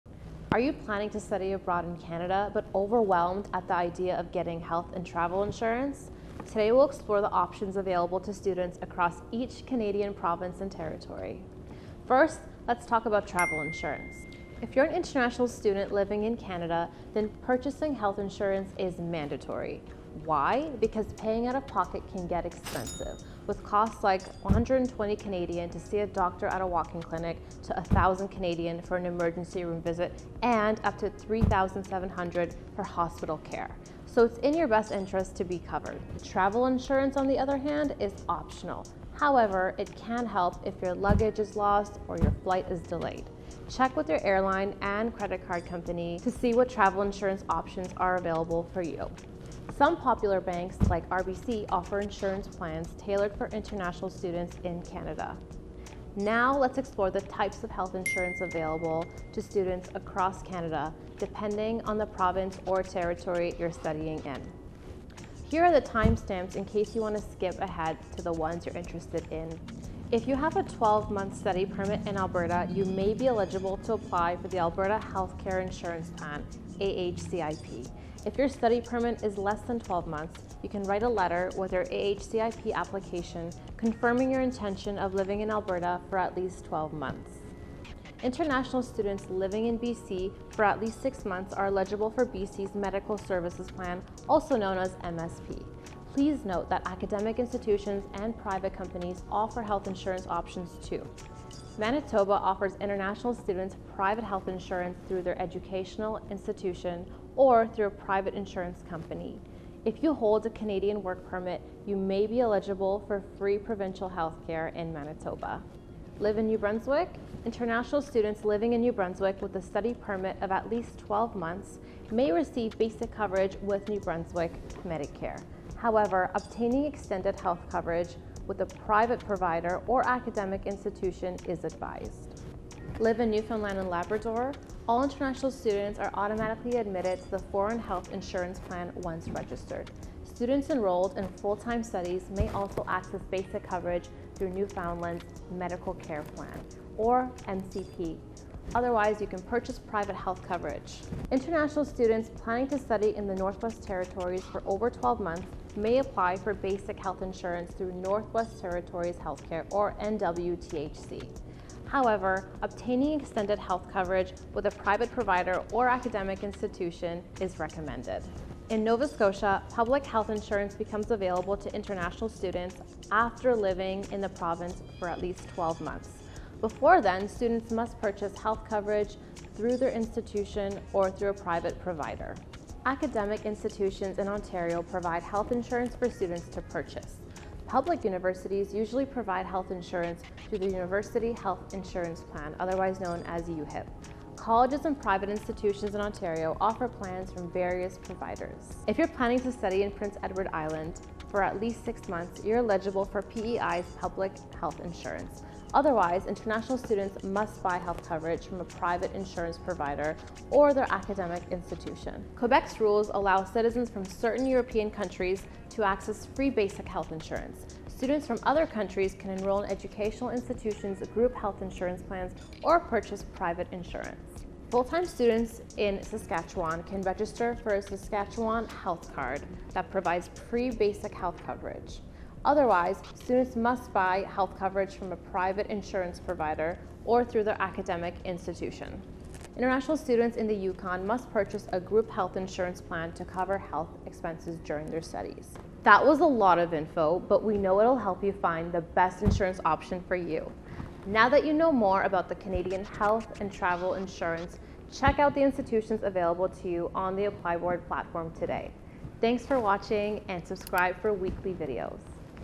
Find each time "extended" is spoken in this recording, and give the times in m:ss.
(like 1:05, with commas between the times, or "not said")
2:06, 2:43.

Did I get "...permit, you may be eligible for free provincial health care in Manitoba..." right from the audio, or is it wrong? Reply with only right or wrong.
right.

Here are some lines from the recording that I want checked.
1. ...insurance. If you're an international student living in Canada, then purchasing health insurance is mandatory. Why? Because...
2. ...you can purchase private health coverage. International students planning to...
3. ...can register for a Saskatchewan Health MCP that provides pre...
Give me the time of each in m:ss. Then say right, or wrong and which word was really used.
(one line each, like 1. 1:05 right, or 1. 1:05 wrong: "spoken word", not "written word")
1. 0:13 right
2. 2:29 right
3. 3:46 wrong: "Card", not "MCP".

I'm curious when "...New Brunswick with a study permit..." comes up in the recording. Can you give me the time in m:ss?
1:58.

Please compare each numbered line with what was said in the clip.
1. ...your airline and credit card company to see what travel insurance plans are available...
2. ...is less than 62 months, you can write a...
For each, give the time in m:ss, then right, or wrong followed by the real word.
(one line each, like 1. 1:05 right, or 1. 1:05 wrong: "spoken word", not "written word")
1. 0:44 wrong: "options", not "plans"
2. 1:19 wrong: "12", not "62".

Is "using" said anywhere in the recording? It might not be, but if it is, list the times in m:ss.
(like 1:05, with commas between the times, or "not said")
not said.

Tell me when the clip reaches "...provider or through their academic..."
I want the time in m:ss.
3:56.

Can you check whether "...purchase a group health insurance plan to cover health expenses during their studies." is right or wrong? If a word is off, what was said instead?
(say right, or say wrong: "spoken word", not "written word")
right.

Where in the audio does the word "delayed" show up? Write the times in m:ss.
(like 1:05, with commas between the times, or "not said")
0:42.